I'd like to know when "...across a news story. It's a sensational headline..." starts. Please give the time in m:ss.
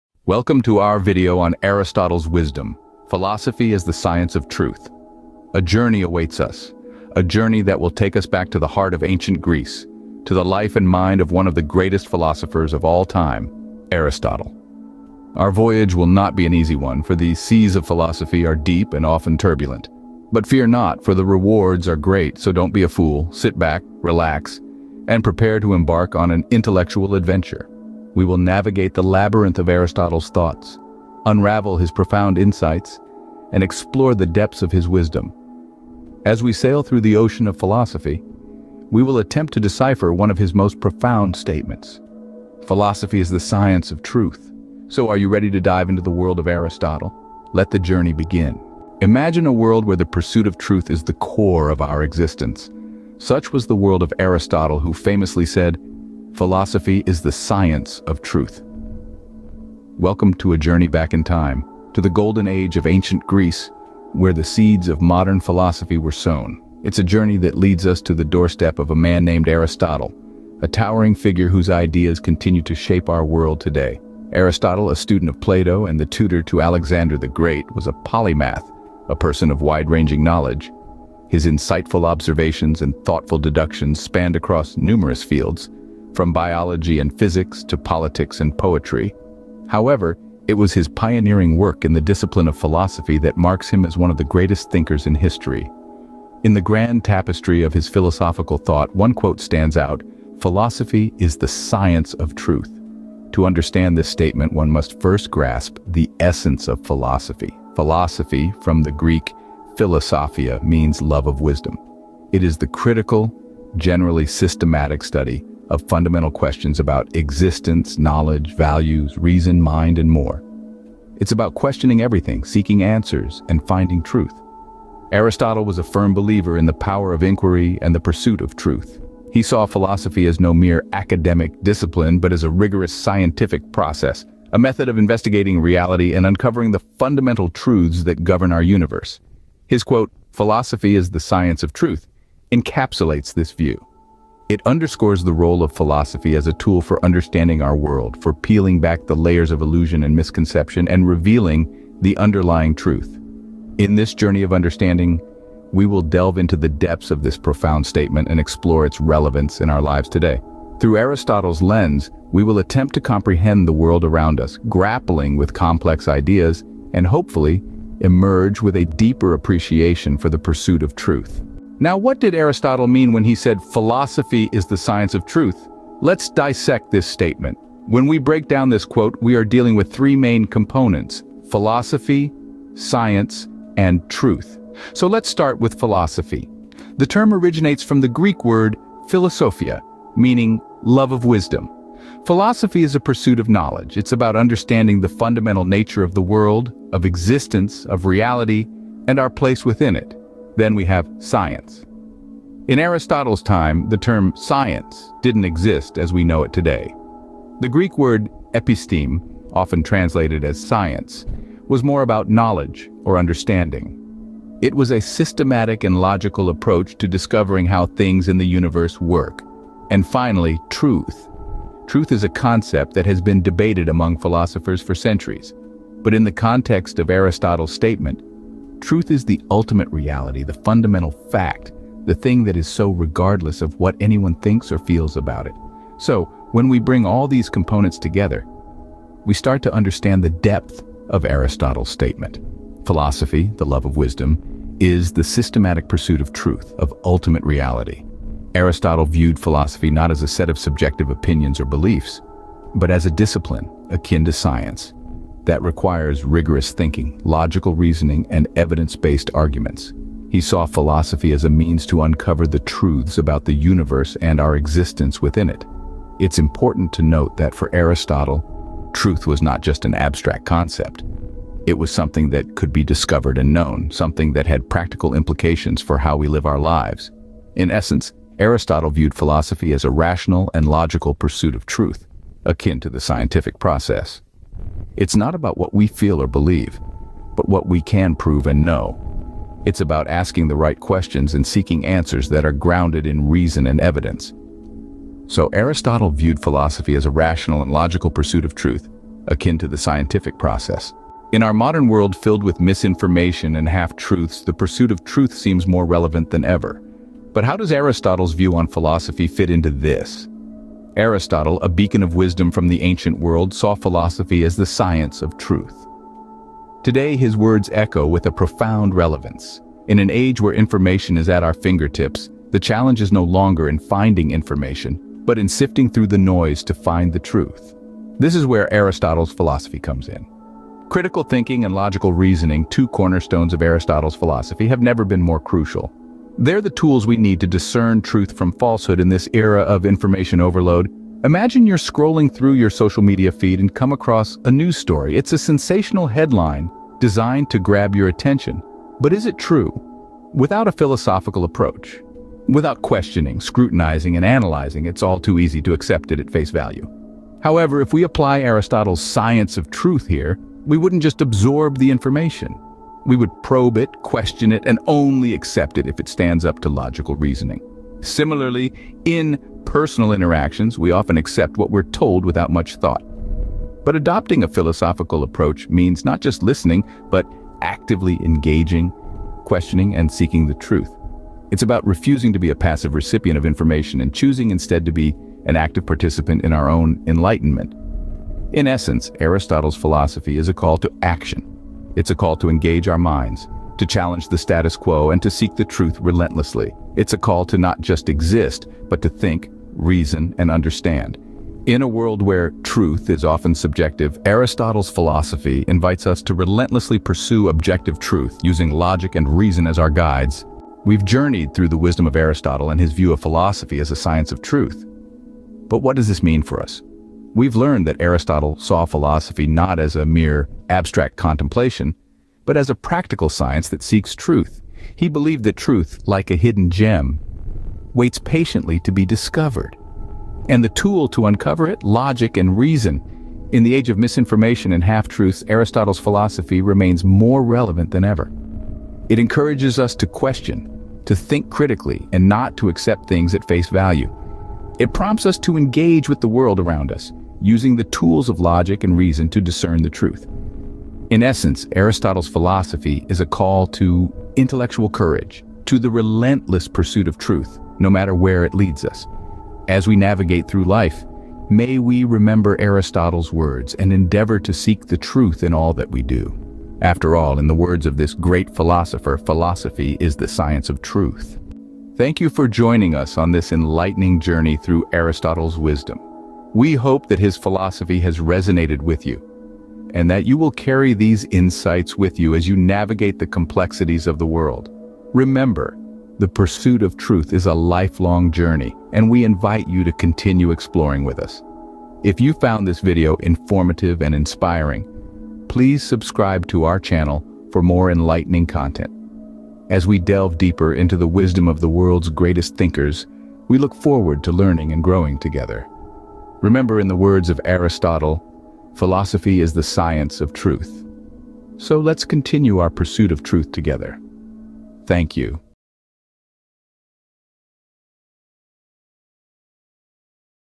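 5:43.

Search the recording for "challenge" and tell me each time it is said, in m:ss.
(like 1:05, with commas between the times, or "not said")
5:22, 6:33.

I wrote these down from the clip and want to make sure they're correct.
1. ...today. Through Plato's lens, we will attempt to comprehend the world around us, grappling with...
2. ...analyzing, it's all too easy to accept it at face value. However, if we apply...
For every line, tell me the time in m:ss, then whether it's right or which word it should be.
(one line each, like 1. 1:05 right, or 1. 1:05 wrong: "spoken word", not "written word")
1. 2:40 wrong: "Aristotle", not "Plato"
2. 5:54 right.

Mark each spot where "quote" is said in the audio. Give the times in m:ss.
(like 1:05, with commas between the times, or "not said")
1:39, 2:19, 2:58.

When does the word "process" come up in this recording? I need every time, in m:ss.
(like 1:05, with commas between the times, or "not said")
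2:13, 4:43, 5:00.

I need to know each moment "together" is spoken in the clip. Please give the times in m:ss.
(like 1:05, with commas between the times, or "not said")
3:57, 8:25, 8:33.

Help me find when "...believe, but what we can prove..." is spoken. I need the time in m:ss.
4:46.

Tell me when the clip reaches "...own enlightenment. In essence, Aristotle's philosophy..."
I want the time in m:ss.
6:26.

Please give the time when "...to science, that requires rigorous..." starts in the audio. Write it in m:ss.
4:14.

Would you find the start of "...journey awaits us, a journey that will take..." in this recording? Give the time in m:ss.
0:05.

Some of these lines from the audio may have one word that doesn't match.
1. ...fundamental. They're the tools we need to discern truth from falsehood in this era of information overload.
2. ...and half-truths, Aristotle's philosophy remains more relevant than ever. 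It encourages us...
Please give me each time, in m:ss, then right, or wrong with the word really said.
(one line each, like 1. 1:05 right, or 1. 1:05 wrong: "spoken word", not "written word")
1. 5:35 wrong: "crucial", not "fundamental"
2. 7:14 right.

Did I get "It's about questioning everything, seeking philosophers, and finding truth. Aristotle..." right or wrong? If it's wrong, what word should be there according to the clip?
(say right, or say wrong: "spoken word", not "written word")
wrong: "answers", not "philosophers".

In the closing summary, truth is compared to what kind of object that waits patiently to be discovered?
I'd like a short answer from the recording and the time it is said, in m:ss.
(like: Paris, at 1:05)
A hidden gem, at 7:06.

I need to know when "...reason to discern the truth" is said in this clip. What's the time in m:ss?
7:28.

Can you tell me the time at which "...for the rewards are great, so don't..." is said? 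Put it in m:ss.
0:21.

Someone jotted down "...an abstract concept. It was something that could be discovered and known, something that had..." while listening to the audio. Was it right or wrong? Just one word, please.
right.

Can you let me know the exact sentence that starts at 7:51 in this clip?
Thank you for joining us on this enlightening journey through Aristotle's wisdom.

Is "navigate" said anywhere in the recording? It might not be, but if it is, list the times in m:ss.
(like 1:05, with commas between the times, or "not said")
0:28, 7:39, 8:02.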